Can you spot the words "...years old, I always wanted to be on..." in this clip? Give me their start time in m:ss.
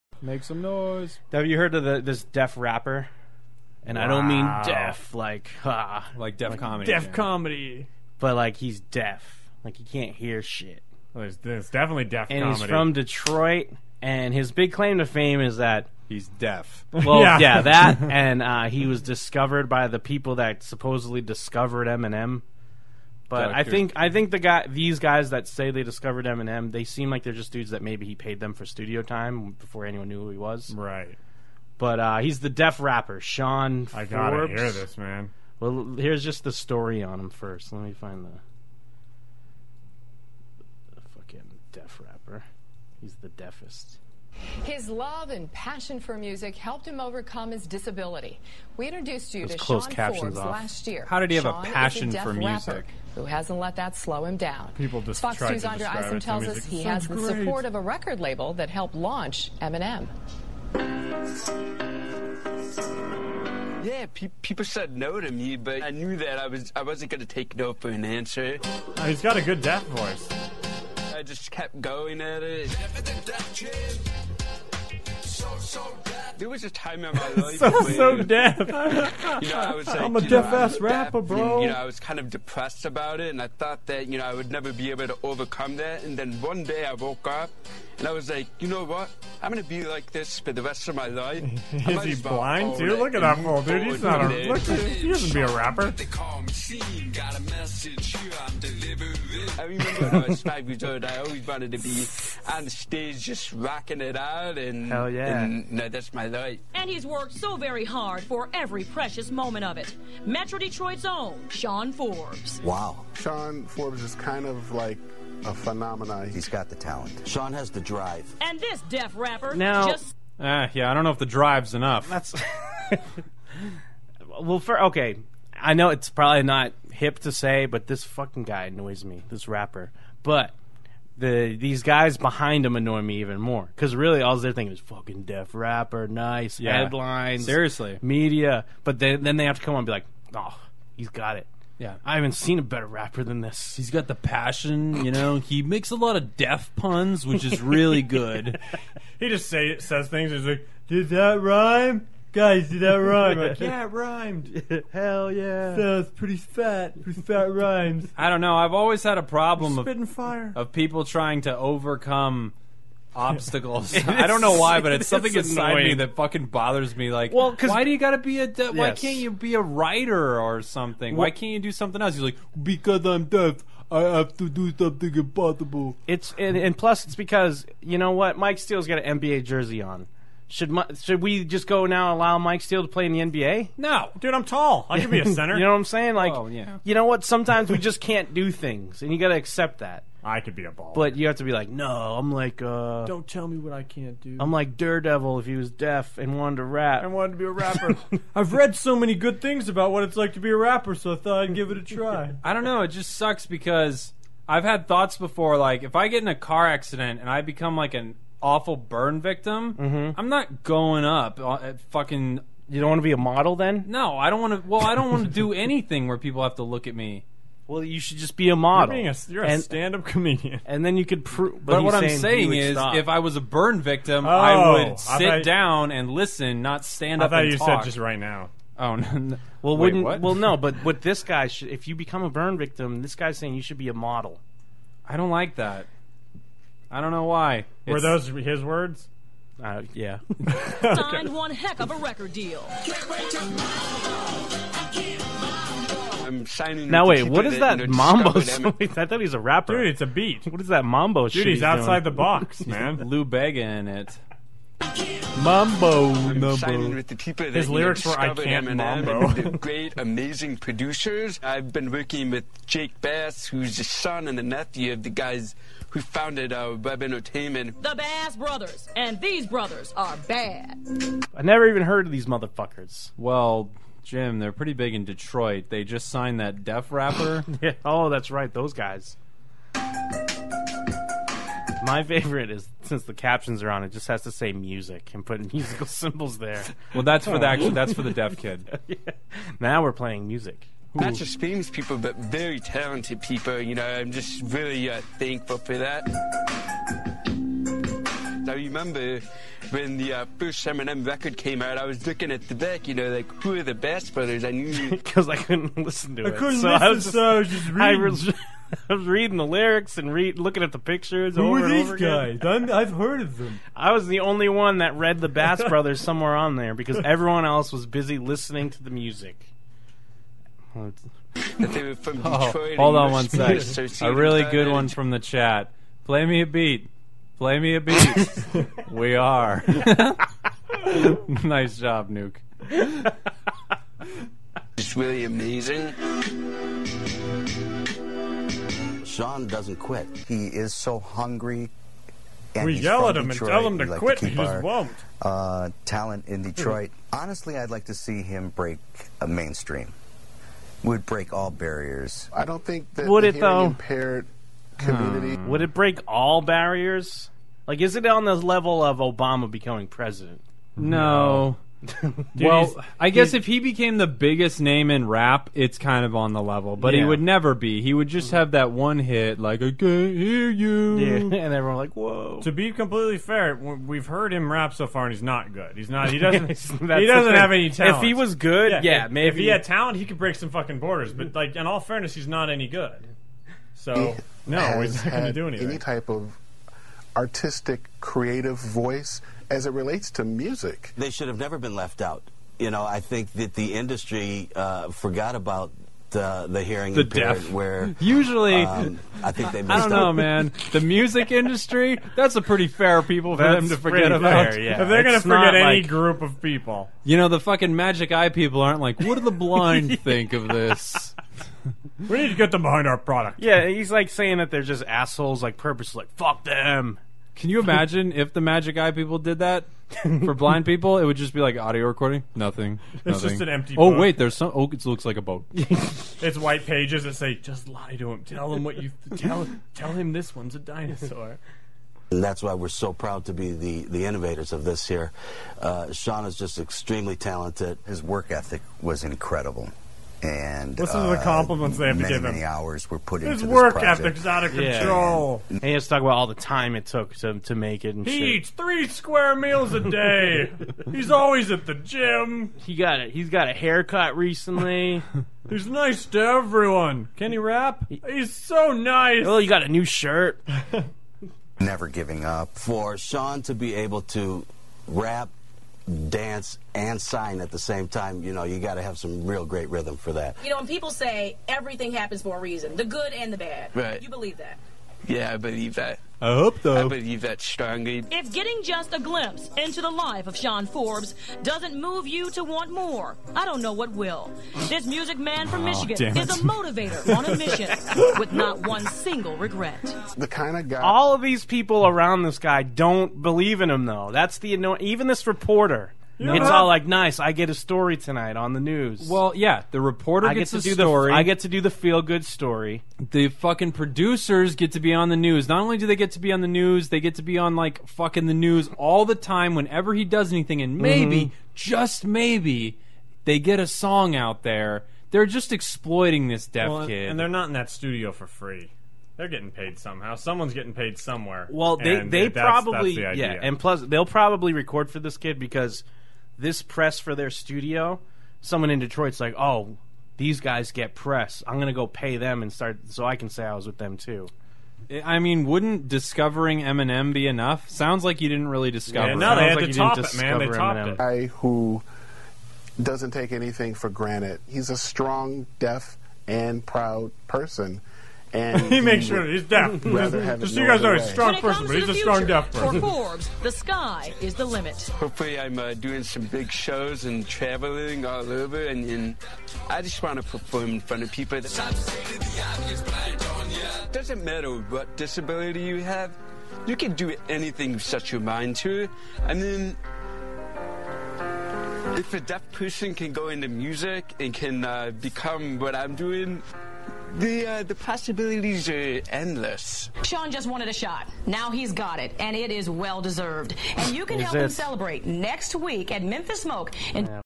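1:40.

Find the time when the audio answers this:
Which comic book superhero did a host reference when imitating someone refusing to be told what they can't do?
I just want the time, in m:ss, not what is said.
3:14.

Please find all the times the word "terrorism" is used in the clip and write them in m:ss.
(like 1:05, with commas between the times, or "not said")
not said.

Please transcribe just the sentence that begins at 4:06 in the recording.
now wait, what is that mambo?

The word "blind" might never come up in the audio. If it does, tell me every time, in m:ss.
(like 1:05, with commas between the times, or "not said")
1:32, 6:49, 7:00.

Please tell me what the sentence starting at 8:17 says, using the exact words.
I get a story tonight on the news.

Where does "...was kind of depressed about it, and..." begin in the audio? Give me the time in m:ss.
1:21.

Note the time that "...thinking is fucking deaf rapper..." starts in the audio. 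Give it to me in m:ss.
2:14.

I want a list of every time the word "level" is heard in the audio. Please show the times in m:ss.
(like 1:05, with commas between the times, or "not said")
5:58, 6:06.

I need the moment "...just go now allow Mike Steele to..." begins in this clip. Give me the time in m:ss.
3:01.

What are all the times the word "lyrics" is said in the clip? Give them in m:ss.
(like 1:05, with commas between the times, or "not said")
4:17, 5:09.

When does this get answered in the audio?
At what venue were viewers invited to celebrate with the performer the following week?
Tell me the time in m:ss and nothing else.
9:46.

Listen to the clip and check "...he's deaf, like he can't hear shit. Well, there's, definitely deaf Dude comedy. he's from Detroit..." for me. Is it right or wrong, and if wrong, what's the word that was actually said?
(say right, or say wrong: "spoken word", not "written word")
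wrong: "And", not "Dude".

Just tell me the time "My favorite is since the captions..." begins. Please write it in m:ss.
4:41.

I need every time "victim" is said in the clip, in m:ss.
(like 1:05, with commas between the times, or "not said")
3:29, 3:43, 3:52.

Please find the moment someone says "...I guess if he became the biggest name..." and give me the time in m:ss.
6:02.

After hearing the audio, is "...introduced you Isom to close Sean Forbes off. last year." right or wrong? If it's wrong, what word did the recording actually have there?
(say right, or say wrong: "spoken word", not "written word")
wrong: "Those", not "Isom".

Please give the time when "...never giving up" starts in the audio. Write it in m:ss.
7:41.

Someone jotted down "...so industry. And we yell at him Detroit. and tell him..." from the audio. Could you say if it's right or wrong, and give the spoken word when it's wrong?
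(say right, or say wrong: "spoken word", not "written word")
wrong: "hungry", not "industry".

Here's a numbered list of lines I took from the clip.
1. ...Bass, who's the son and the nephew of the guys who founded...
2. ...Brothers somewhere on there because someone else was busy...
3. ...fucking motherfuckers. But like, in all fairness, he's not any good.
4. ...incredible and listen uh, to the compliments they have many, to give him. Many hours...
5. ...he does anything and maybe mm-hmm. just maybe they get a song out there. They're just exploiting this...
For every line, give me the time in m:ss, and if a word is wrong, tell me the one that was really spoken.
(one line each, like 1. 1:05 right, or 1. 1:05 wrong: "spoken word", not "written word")
1. 4:23 right
2. 5:15 wrong: "everyone", not "someone"
3. 6:20 wrong: "borders", not "motherfuckers"
4. 7:19 right
5. 8:29 right.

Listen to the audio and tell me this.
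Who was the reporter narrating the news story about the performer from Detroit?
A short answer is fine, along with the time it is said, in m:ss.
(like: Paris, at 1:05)
Andrea Isom, at 0:55.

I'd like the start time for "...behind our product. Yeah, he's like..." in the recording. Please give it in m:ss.
6:52.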